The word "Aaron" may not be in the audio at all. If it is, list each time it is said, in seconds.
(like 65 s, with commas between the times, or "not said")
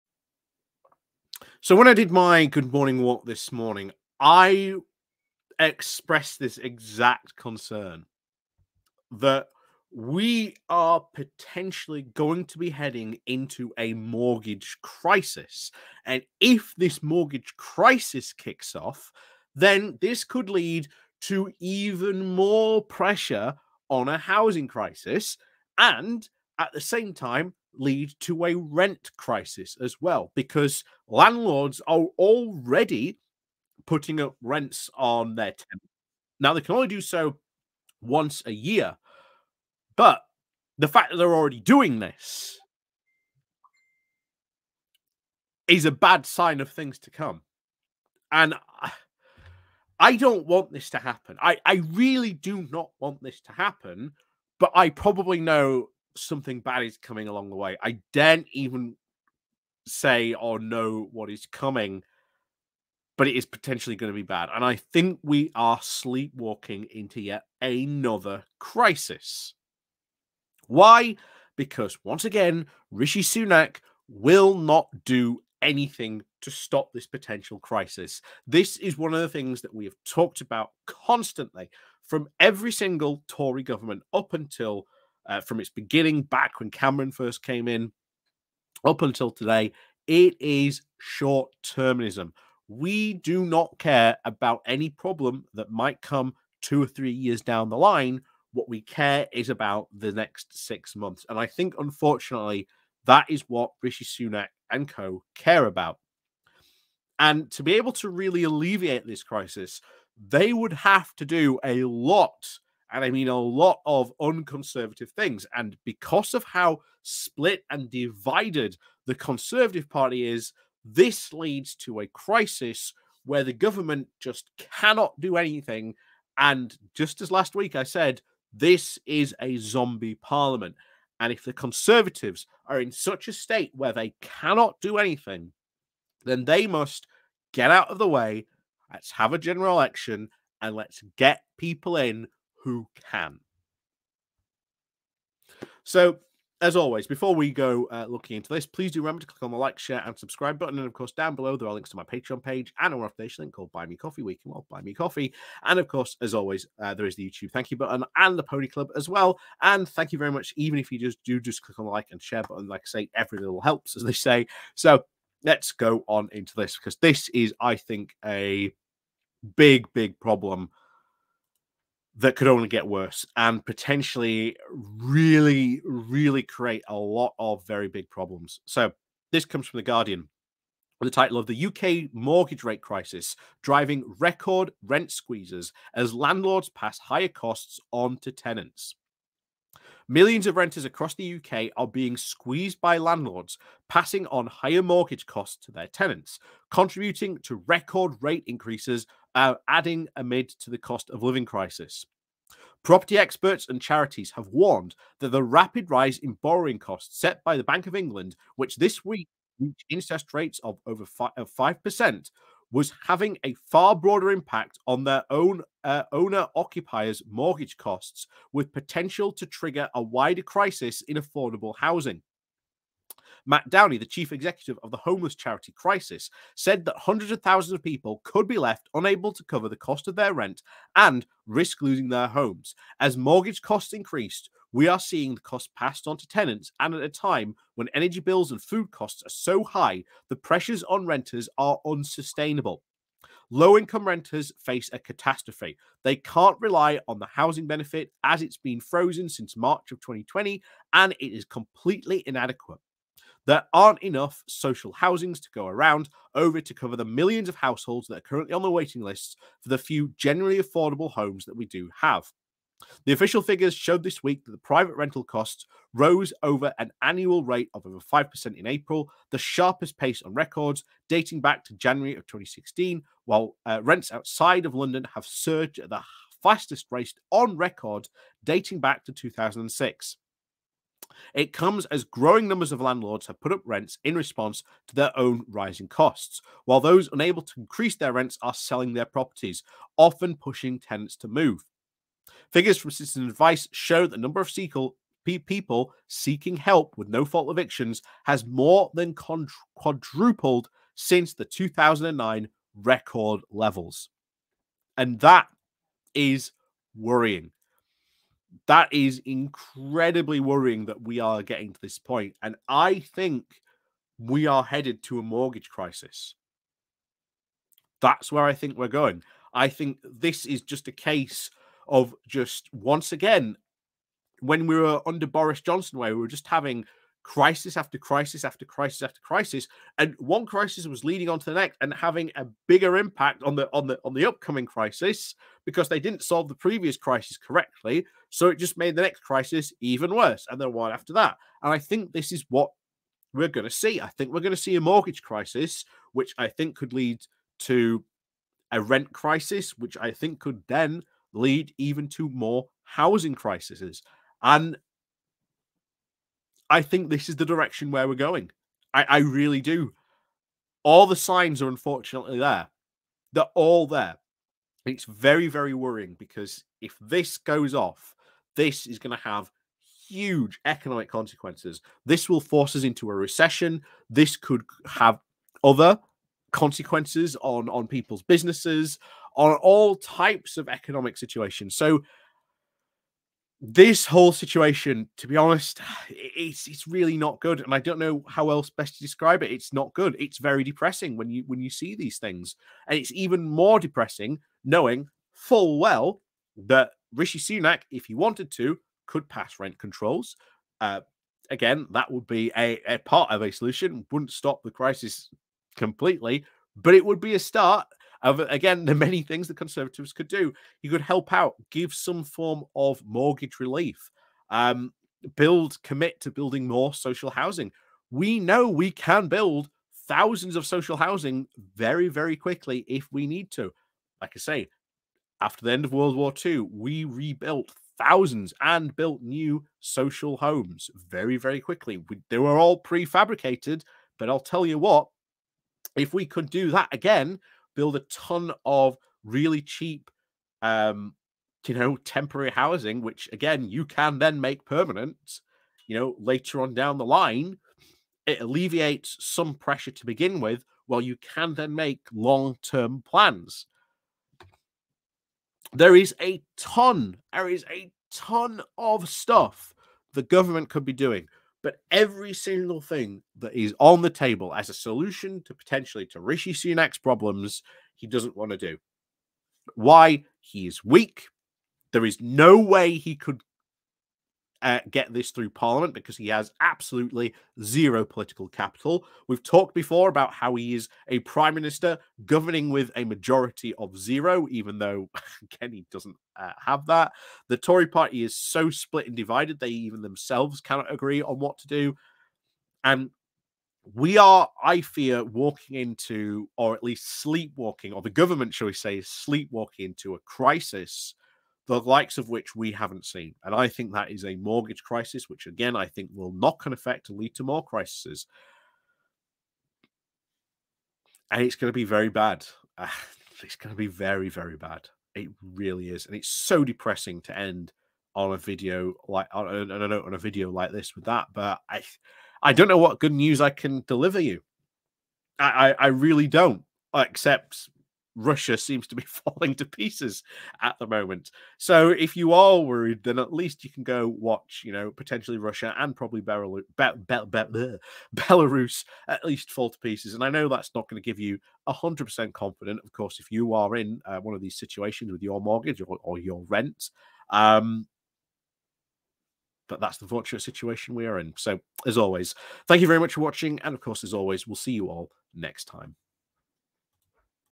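not said.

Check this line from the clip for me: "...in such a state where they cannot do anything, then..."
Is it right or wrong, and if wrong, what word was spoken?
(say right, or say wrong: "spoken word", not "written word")
right.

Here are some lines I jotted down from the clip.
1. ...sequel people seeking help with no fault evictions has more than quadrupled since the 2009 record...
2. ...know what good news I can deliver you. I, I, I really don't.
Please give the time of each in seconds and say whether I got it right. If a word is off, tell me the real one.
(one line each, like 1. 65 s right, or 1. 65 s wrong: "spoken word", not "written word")
1. 294 s right
2. 522 s right.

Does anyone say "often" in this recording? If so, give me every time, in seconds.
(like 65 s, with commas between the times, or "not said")
289 s.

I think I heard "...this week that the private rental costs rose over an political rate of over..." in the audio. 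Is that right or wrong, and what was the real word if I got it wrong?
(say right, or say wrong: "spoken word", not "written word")
wrong: "annual", not "political".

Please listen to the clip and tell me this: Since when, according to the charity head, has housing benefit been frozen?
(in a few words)
March 2020.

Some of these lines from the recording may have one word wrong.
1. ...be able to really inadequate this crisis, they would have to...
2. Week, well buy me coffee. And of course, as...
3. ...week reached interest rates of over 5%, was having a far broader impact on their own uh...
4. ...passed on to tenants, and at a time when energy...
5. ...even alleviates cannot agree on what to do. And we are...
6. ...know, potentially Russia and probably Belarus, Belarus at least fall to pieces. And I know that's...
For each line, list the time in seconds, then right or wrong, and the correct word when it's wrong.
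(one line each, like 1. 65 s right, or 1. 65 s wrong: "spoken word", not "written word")
1. 107 s wrong: "alleviate", not "inadequate"
2. 154 s right
3. 209 s right
4. 235 s right
5. 489 s wrong: "themselves", not "alleviates"
6. 534 s right.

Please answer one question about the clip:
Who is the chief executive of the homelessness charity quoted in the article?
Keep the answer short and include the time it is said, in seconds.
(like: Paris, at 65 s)
Matt Downie, at 223 s.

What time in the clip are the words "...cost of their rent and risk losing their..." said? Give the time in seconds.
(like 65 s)
229 s.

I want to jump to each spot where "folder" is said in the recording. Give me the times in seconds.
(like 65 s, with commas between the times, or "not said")
not said.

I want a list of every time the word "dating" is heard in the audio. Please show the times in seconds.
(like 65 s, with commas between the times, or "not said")
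271 s, 278 s.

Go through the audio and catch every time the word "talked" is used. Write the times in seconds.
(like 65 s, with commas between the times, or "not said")
80 s, 479 s.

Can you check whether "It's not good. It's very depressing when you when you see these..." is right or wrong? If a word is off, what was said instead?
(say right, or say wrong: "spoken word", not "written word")
right.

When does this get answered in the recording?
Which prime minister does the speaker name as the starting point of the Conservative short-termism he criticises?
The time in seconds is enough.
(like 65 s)
86 s.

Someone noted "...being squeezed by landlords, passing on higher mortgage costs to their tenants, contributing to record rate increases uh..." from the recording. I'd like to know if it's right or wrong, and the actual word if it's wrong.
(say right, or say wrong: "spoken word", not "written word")
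right.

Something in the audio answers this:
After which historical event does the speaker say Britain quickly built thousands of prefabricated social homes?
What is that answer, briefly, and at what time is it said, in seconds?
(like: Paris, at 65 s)
World War II, at 425 s.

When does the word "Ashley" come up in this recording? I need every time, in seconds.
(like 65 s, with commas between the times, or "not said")
not said.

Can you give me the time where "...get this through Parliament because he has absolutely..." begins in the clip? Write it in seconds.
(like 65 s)
474 s.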